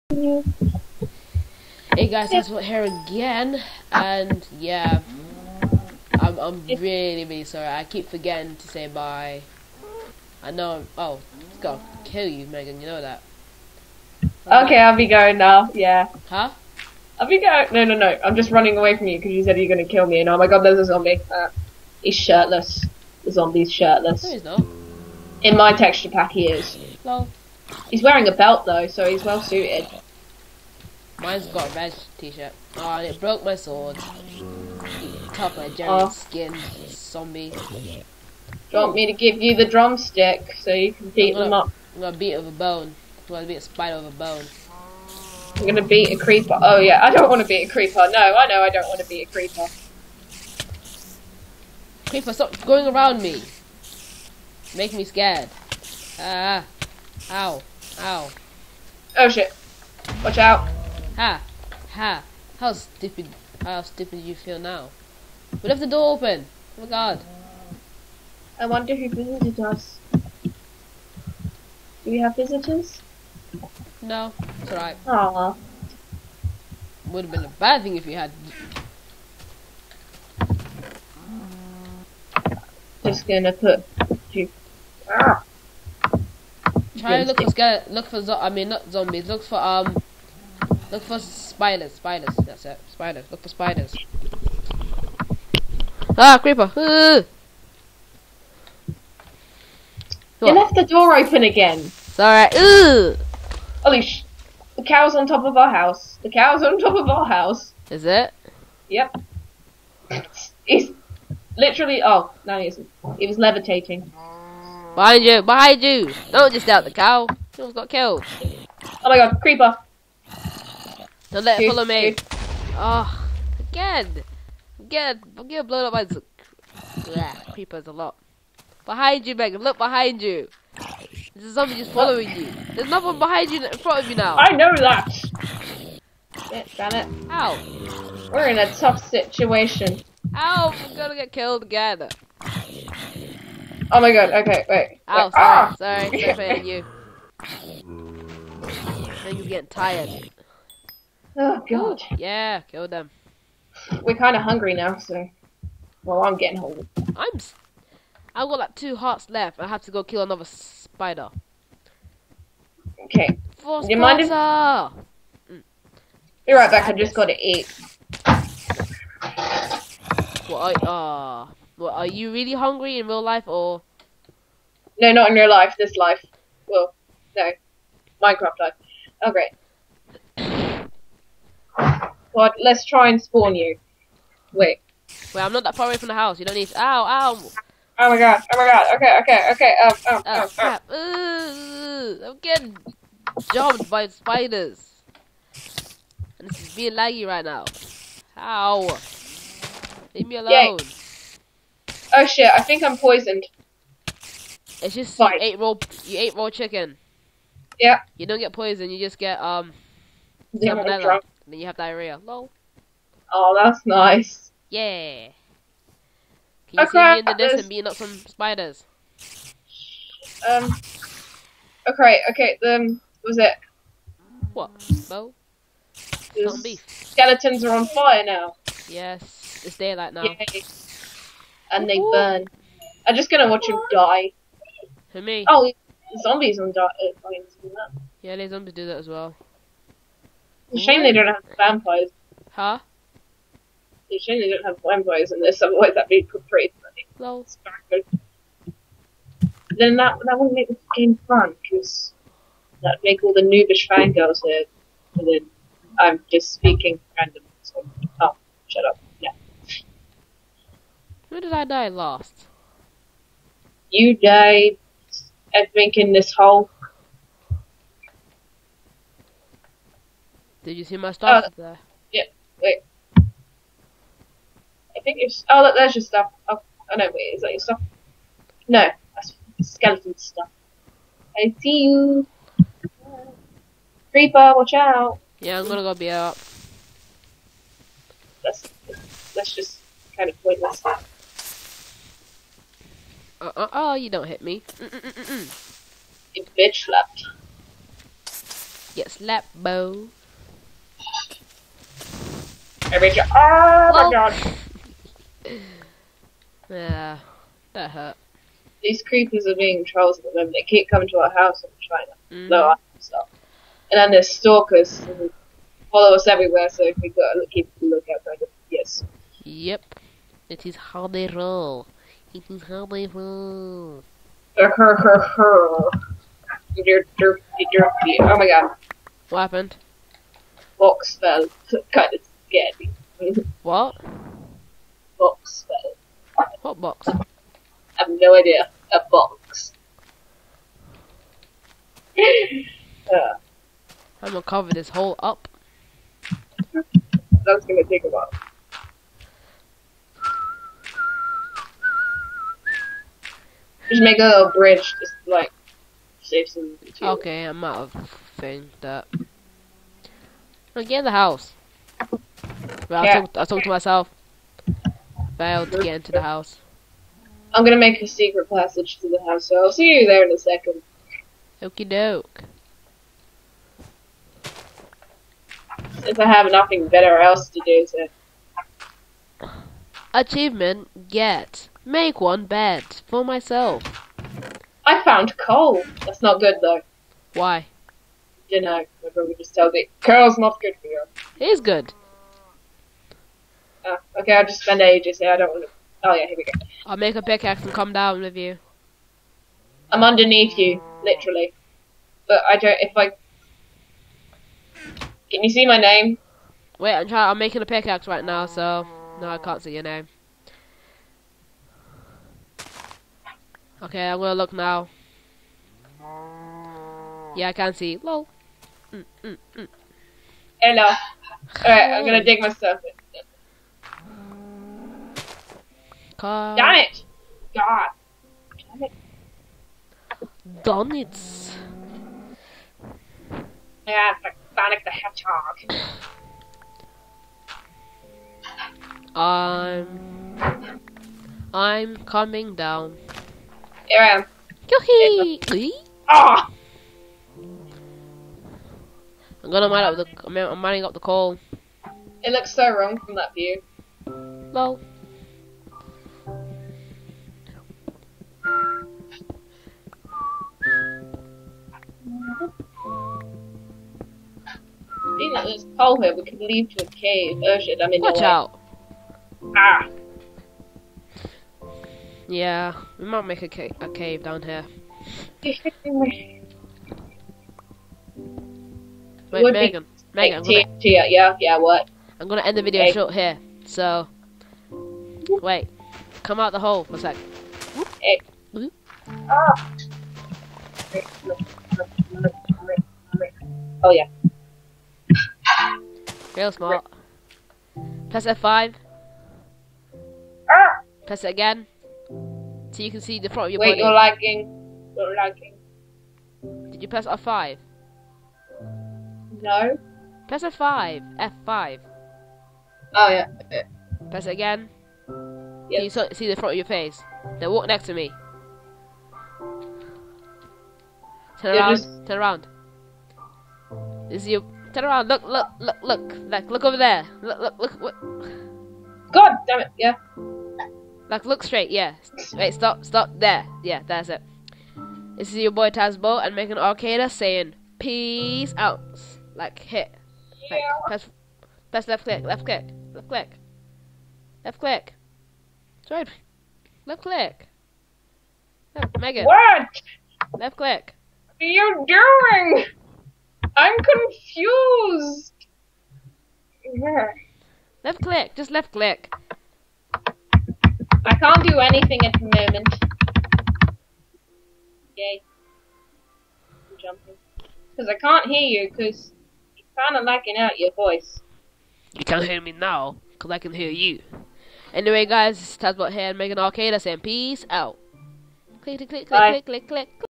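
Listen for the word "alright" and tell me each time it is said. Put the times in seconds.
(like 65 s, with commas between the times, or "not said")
74 s, 102 s, 420 s.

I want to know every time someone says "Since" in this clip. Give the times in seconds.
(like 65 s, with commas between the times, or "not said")
376 s.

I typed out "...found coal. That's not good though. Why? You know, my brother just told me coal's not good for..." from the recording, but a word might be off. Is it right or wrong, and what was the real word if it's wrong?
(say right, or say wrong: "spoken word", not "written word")
right.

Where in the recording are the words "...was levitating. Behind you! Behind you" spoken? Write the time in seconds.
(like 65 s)
113 s.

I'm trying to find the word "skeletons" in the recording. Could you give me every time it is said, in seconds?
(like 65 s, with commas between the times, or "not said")
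225 s, 279 s.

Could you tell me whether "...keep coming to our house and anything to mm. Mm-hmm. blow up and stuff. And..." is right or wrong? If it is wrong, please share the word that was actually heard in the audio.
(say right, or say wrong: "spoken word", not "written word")
wrong: "trying", not "anything".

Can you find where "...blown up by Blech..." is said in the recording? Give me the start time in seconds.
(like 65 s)
125 s.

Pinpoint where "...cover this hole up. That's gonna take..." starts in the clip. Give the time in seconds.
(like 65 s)
344 s.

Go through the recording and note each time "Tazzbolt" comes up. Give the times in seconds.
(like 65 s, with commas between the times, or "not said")
535 s, 575 s.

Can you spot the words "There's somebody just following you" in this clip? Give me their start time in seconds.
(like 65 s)
131 s.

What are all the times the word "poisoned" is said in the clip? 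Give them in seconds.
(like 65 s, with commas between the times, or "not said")
202 s, 208 s.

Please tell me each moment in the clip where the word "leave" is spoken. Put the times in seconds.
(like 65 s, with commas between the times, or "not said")
200 s, 466 s.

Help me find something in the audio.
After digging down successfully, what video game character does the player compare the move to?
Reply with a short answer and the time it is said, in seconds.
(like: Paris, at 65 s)
Sonic the Hedgehog, at 434 s.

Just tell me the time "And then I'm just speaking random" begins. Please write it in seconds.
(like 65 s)
255 s.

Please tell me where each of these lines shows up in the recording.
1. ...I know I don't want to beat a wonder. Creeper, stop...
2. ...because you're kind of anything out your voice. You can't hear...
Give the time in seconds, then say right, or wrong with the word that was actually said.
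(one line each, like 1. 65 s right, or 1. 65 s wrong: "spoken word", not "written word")
1. 48 s wrong: "creeper", not "wonder"
2. 568 s wrong: "lacking", not "anything".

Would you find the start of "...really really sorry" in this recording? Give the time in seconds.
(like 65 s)
6 s.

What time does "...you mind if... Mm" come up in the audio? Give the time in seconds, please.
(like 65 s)
163 s.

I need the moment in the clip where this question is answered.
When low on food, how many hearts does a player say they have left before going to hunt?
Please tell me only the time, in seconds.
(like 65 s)
158 s.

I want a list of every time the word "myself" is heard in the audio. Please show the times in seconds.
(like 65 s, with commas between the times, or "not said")
363 s, 383 s, 422 s.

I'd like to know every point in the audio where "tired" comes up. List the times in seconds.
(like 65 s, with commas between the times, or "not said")
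149 s.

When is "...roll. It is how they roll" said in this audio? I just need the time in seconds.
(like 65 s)
321 s.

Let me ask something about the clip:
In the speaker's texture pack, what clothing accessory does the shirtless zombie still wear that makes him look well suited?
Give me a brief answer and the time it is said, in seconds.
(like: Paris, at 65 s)
A belt, at 28 s.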